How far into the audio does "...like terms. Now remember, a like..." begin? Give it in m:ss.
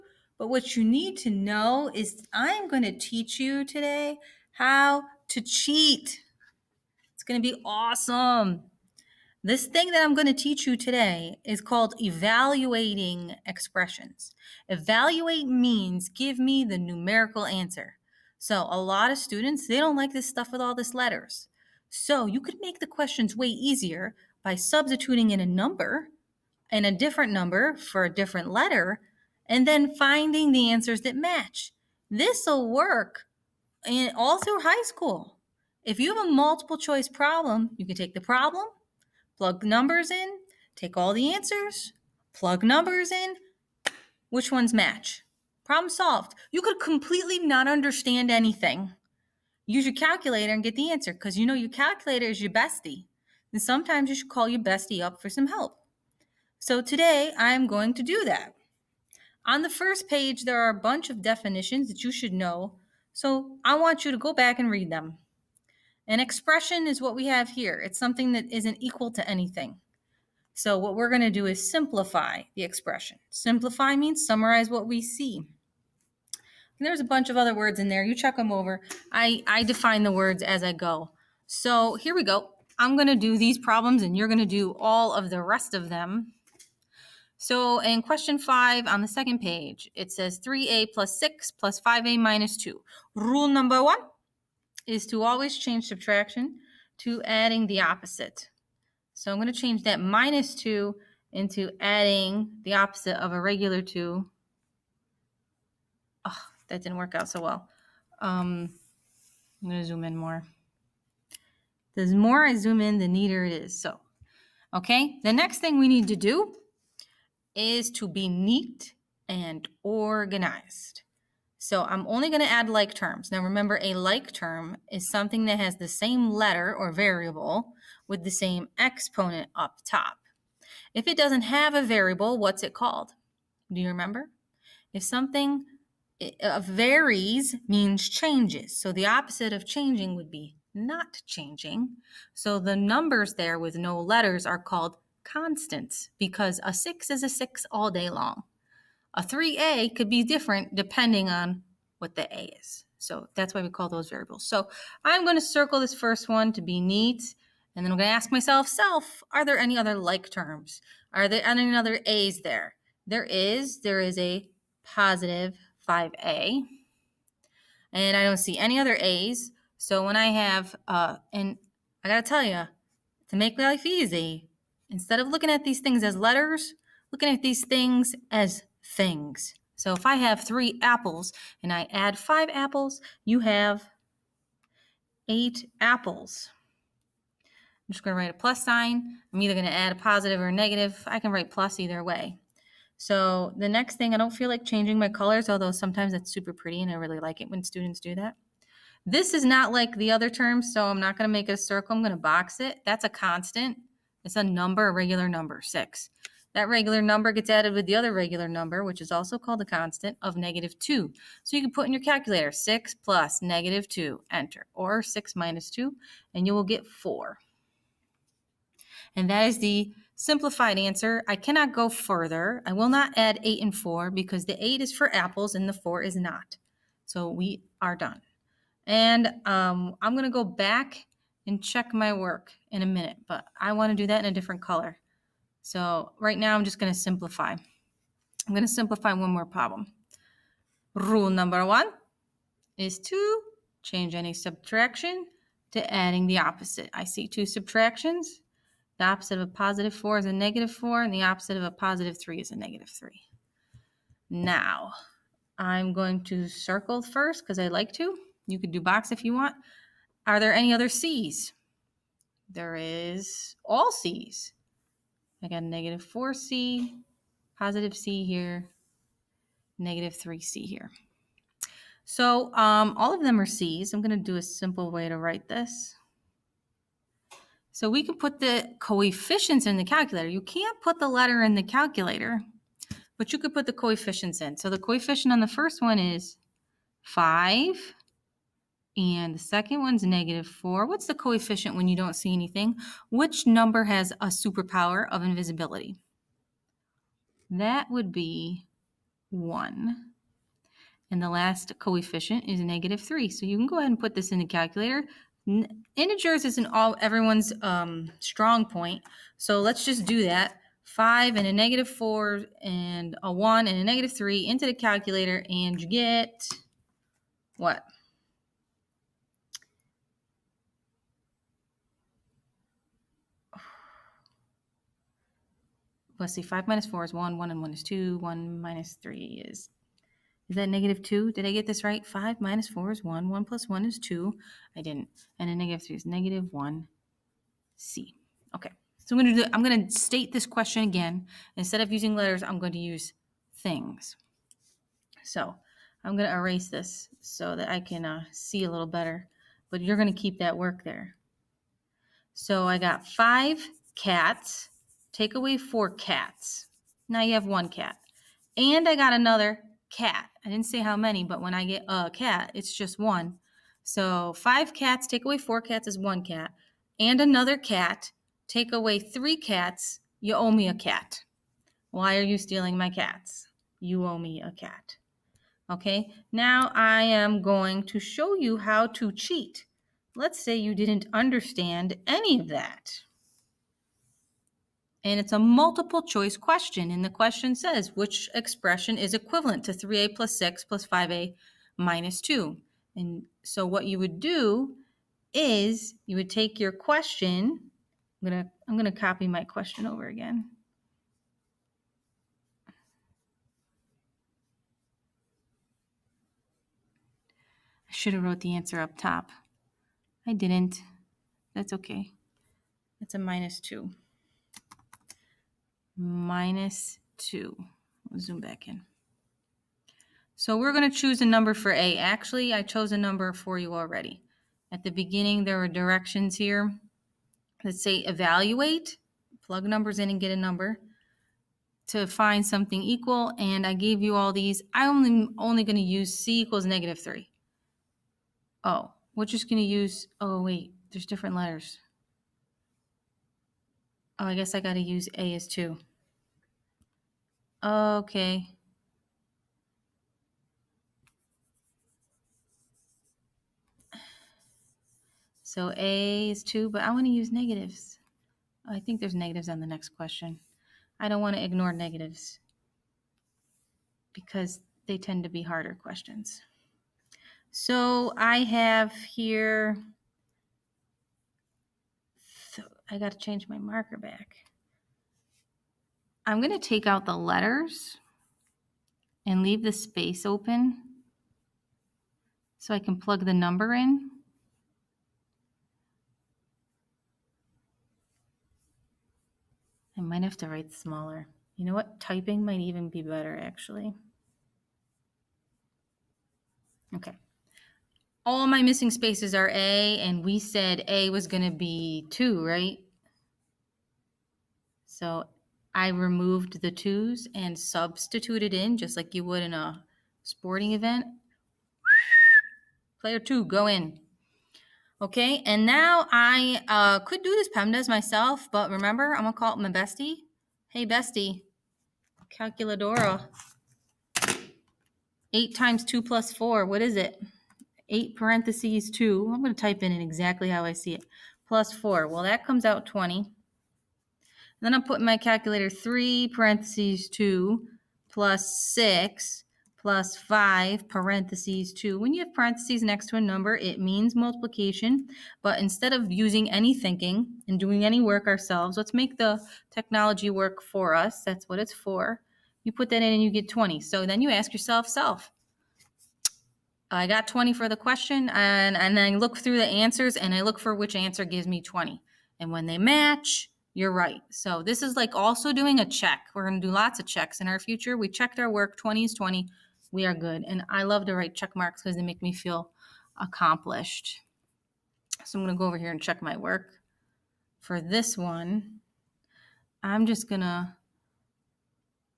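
2:02.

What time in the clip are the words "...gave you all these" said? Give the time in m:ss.
7:13.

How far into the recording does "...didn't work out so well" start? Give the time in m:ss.
1:46.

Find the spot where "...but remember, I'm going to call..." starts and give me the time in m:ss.
8:38.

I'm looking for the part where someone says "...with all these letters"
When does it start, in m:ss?
0:20.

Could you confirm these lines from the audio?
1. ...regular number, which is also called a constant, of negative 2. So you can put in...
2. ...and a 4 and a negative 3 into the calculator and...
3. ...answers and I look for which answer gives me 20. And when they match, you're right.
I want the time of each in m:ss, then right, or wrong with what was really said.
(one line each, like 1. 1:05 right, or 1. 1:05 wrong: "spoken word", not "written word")
1. 3:28 right
2. 5:12 wrong: "1", not "4"
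3. 9:19 right.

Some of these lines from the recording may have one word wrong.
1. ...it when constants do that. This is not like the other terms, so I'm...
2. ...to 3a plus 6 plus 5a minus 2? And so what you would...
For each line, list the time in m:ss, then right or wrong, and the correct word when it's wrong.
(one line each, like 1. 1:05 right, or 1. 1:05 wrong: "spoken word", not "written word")
1. 3:17 wrong: "students", not "constants"
2. 6:29 right.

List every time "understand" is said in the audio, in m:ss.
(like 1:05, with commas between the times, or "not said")
0:47, 6:21.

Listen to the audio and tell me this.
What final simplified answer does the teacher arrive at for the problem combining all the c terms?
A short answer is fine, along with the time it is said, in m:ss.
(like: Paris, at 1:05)
-1c, at 5:36.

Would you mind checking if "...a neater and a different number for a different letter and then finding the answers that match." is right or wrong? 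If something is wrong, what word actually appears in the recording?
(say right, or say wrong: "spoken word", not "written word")
wrong: "number", not "neater".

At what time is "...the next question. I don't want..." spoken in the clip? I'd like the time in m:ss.
7:39.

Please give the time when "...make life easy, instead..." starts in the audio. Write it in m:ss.
2:53.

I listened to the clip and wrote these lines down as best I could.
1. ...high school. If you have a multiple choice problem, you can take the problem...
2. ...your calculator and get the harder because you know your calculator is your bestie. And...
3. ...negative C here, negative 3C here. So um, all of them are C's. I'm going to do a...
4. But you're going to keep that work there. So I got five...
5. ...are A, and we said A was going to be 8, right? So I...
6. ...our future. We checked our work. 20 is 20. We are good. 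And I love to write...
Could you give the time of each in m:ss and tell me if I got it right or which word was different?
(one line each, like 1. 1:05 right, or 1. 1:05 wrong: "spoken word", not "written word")
1. 0:34 right
2. 0:49 wrong: "answer", not "harder"
3. 4:27 wrong: "positive", not "negative"
4. 5:49 right
5. 8:19 wrong: "2", not "8"
6. 9:27 right.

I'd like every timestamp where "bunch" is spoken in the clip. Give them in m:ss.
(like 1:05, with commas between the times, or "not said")
1:00, 1:17.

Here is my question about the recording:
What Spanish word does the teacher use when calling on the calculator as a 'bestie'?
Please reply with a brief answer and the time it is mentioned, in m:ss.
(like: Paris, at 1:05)
calculadora, at 8:42.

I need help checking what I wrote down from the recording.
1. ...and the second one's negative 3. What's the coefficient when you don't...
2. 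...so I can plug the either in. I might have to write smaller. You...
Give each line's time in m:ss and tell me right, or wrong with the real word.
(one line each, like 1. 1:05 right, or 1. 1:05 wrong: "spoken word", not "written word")
1. 4:48 wrong: "4", not "3"
2. 8:02 wrong: "number", not "either".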